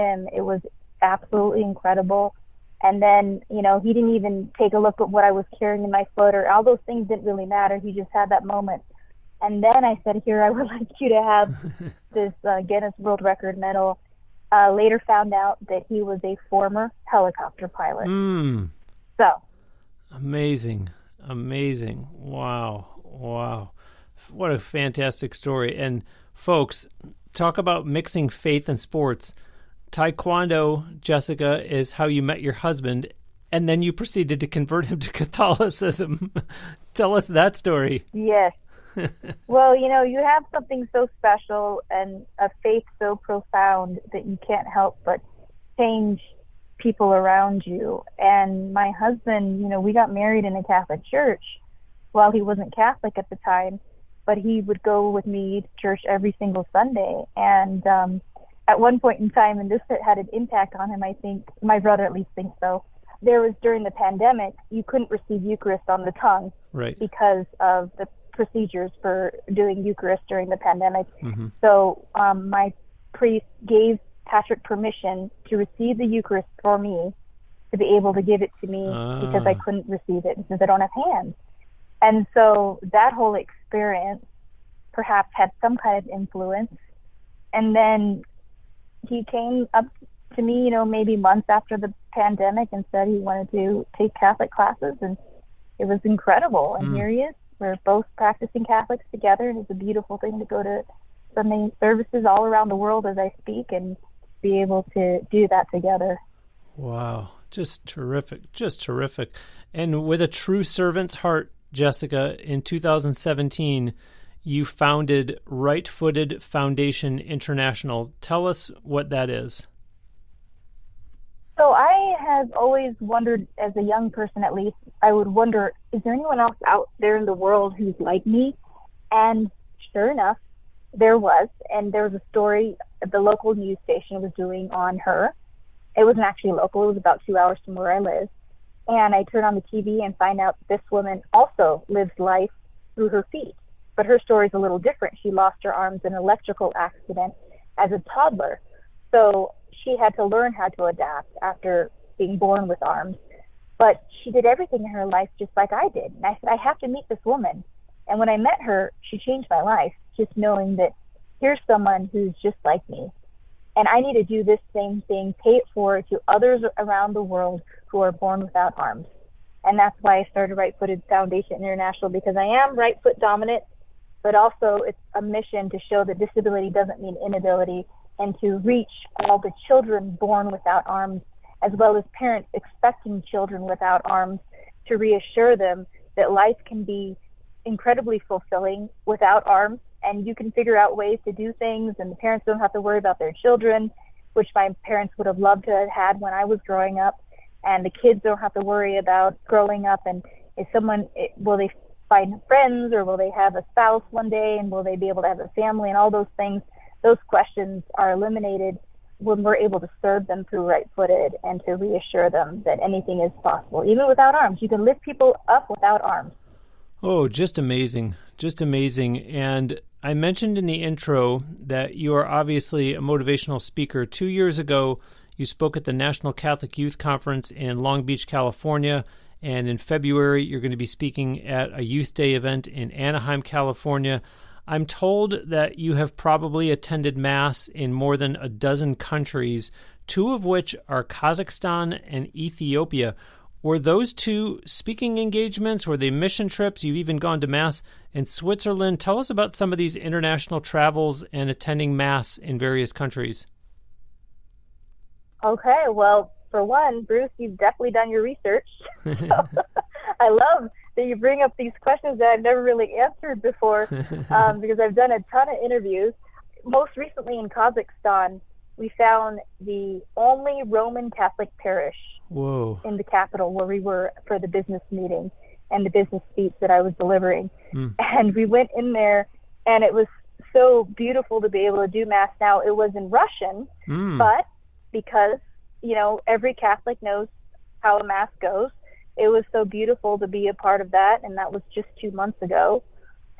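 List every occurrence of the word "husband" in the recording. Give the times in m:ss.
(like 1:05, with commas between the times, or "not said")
0:32, 0:48.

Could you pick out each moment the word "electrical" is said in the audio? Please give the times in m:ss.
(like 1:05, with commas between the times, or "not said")
2:26.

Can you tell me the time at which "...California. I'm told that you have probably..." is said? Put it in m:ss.
3:53.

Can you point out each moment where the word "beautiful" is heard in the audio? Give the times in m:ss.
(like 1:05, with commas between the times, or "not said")
1:39, 4:40, 4:49.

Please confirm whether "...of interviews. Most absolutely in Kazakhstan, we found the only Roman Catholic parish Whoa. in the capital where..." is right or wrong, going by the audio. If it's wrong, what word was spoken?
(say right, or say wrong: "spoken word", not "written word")
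wrong: "recently", not "absolutely".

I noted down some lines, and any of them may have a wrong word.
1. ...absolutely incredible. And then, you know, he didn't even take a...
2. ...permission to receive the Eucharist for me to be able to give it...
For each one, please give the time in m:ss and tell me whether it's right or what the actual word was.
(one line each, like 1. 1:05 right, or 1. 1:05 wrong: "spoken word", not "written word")
1. 0:01 right
2. 1:14 right.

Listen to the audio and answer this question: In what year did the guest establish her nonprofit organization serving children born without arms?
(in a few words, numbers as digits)
2017.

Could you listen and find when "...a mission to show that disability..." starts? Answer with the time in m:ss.
2:55.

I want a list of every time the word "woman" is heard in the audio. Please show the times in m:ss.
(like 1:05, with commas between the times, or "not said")
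2:20, 2:37.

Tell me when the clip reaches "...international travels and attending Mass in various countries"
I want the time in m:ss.
4:09.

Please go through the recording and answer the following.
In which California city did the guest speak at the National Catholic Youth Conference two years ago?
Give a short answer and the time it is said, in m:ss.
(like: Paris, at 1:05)
Long Beach, at 3:47.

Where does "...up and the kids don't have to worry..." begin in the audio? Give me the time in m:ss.
3:16.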